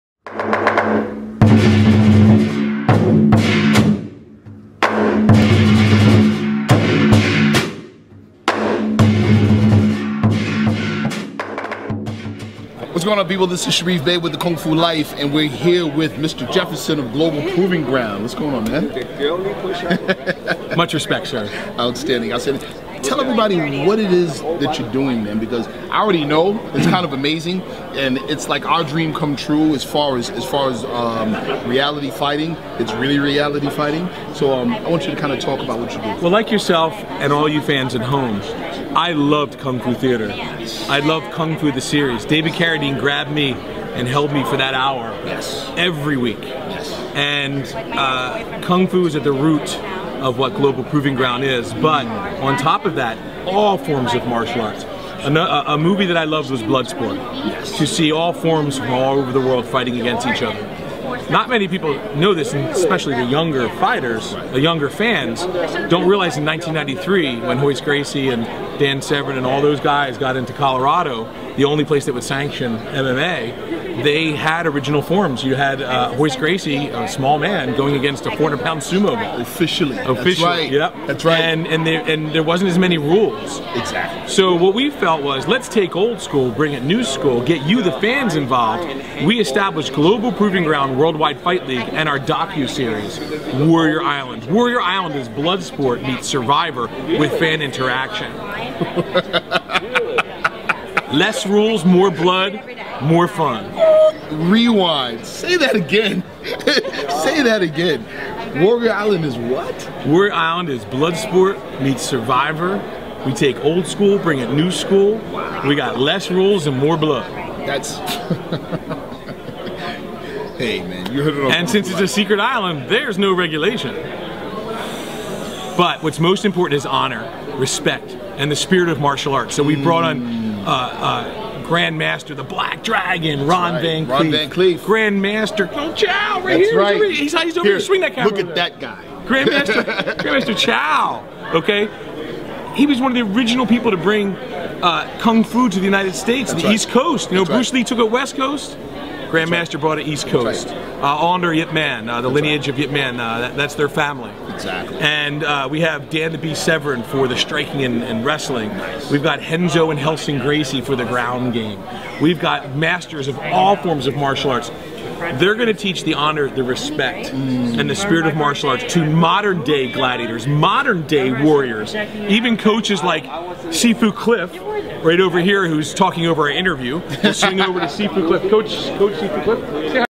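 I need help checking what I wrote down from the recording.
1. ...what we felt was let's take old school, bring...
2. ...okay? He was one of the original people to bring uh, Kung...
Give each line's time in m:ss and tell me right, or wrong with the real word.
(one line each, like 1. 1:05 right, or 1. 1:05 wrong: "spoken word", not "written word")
1. 1:24 right
2. 2:21 right.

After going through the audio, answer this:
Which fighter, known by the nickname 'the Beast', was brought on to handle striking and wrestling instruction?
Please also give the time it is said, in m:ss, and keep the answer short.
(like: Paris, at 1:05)
Dan Severn, at 2:36.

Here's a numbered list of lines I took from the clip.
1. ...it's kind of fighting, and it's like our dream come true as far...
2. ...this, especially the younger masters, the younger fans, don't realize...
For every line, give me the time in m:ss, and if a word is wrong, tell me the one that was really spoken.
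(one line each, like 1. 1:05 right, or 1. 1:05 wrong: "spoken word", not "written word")
1. 0:26 wrong: "amazing", not "fighting"
2. 1:02 wrong: "fighters", not "masters".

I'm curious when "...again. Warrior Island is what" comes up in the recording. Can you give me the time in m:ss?
1:47.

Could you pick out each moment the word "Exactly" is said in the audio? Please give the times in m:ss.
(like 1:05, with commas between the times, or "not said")
1:23, 2:34.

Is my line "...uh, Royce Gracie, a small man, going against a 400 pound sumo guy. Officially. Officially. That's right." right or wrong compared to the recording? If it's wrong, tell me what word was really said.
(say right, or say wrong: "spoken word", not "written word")
right.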